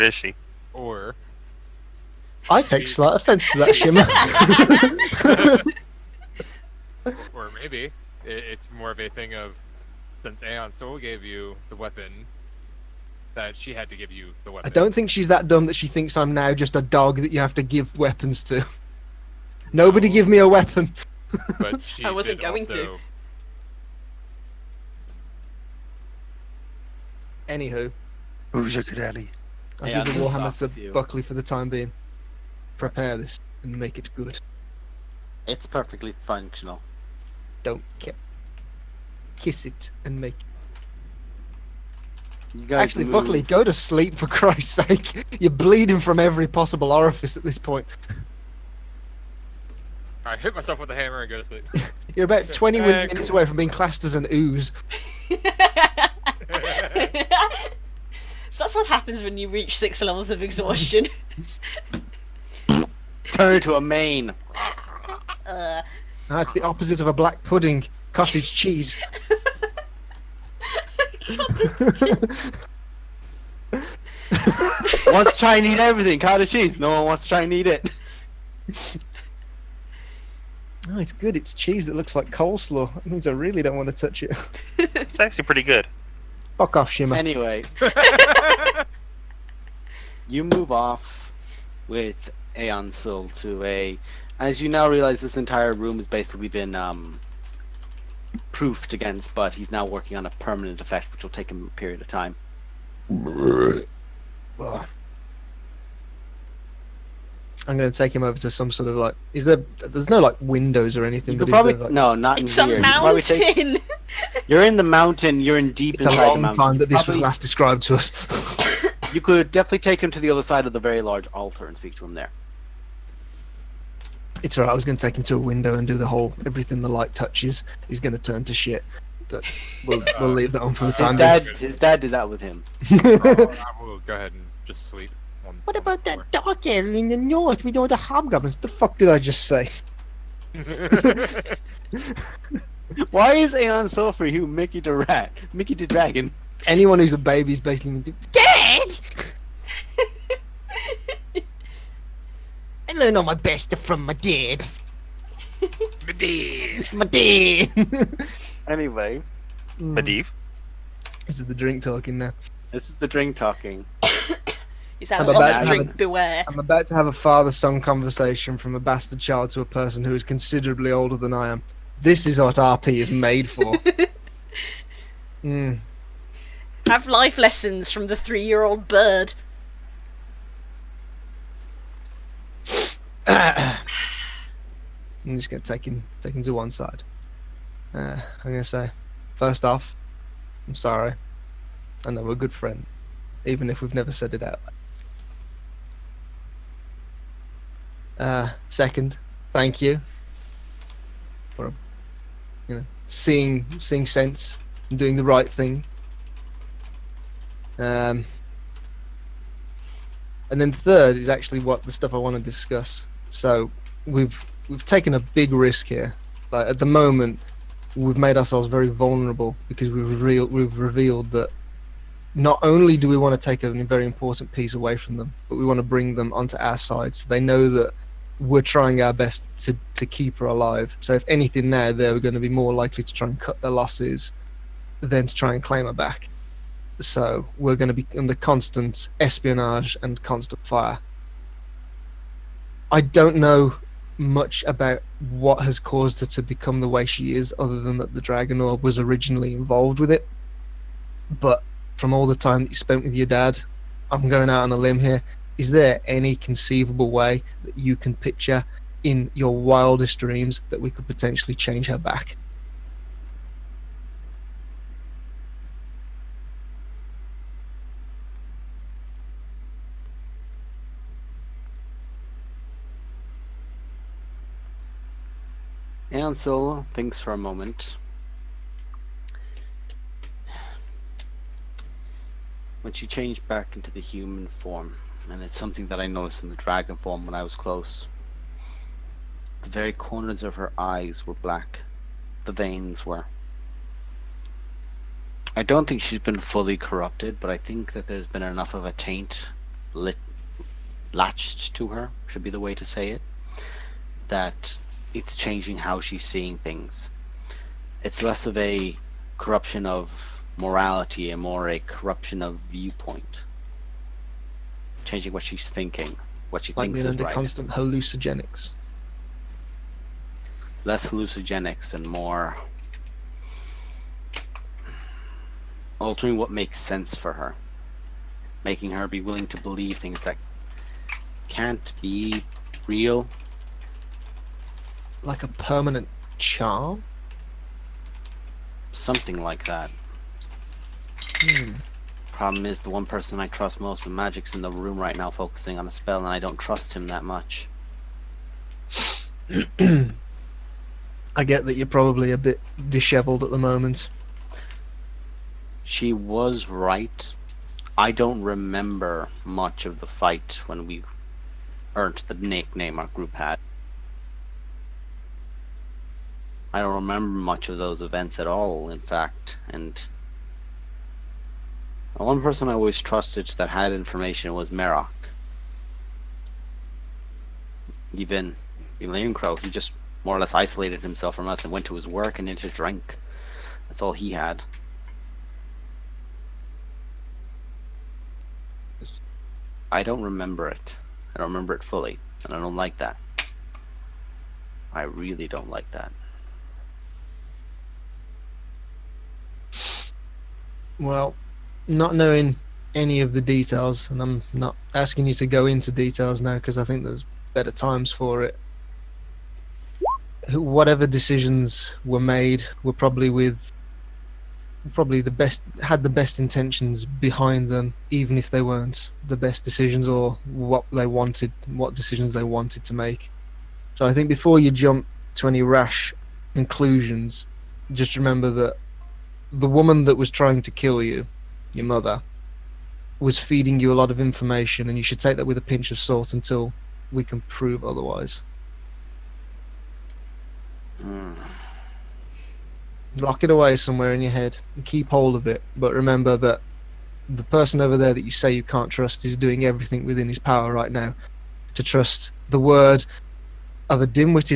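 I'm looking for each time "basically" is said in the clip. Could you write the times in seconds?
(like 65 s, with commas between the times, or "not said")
96 s, 147 s.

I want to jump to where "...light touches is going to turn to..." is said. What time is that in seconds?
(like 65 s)
126 s.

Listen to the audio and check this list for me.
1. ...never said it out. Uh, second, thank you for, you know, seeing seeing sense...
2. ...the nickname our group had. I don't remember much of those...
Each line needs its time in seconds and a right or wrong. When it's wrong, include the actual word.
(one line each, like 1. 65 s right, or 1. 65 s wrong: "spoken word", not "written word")
1. 193 s right
2. 362 s right.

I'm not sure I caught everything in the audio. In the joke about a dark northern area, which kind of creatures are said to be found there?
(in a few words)
hobgoblins.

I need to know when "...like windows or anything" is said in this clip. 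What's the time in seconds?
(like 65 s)
110 s.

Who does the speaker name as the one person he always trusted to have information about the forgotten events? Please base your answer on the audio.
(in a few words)
Merak.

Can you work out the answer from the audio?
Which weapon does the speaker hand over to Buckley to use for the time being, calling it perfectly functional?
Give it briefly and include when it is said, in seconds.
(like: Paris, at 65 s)
Warhammer, at 30 s.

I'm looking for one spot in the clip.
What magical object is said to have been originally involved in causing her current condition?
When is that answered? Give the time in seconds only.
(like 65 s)
248 s.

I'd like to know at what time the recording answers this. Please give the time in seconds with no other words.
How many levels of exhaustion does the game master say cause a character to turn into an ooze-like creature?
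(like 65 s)
59 s.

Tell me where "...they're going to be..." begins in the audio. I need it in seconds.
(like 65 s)
231 s.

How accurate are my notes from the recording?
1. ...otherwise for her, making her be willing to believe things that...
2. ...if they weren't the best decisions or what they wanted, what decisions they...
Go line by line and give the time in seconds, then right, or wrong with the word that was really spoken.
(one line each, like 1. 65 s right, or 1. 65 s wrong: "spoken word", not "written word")
1. 326 s wrong: "sense", not "otherwise"
2. 418 s right.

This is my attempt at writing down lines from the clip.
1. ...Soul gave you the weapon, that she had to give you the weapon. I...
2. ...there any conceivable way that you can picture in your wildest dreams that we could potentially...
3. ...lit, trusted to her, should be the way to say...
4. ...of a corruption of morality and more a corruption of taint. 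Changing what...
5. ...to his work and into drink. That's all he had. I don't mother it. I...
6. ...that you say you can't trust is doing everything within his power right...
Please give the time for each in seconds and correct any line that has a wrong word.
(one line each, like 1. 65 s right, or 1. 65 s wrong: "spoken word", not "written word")
1. 10 s right
2. 255 s right
3. 299 s wrong: "latched", not "trusted"
4. 308 s wrong: "viewpoint", not "taint"
5. 381 s wrong: "remember", not "mother"
6. 448 s right.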